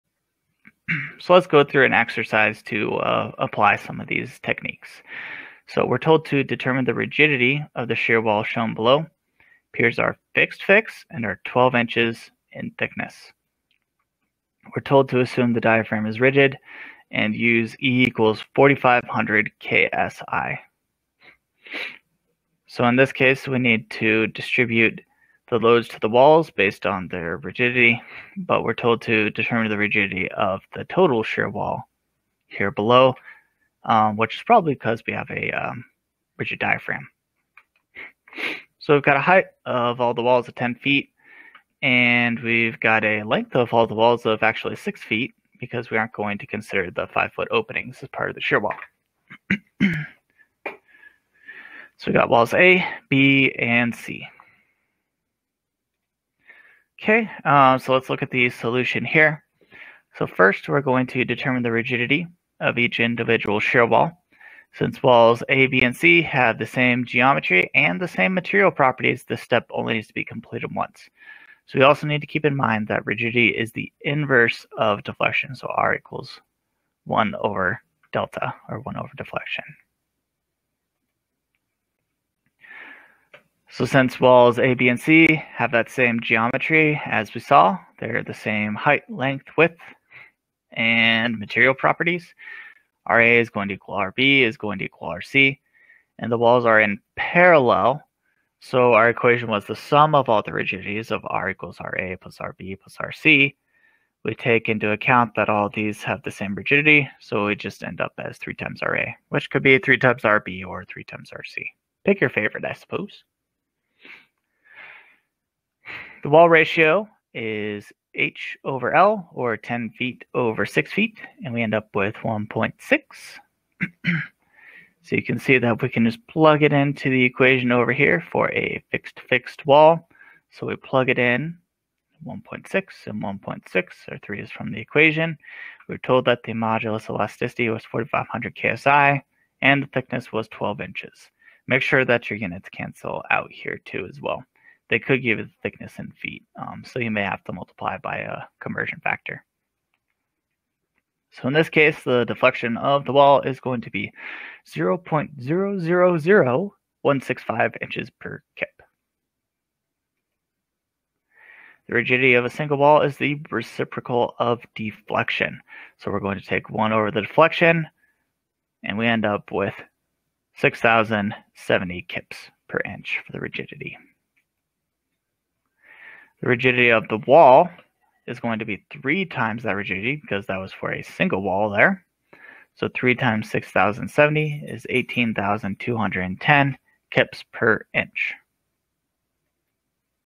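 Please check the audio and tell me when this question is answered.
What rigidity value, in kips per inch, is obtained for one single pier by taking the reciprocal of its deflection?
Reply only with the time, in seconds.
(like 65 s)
170 s.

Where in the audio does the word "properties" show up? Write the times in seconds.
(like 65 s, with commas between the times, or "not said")
68 s, 91 s.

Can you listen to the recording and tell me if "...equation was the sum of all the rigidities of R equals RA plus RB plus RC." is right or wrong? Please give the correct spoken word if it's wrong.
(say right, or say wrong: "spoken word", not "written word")
right.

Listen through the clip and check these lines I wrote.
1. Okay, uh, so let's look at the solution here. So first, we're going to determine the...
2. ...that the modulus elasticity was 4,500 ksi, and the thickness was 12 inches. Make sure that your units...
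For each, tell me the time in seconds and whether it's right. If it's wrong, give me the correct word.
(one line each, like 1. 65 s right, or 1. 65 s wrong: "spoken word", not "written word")
1. 57 s right
2. 136 s right.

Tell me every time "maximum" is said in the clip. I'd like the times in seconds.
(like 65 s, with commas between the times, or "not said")
not said.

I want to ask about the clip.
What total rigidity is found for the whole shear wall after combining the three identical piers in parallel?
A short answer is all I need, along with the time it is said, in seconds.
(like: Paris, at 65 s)
18,210 kips per inch, at 184 s.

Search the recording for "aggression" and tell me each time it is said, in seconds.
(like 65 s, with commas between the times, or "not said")
not said.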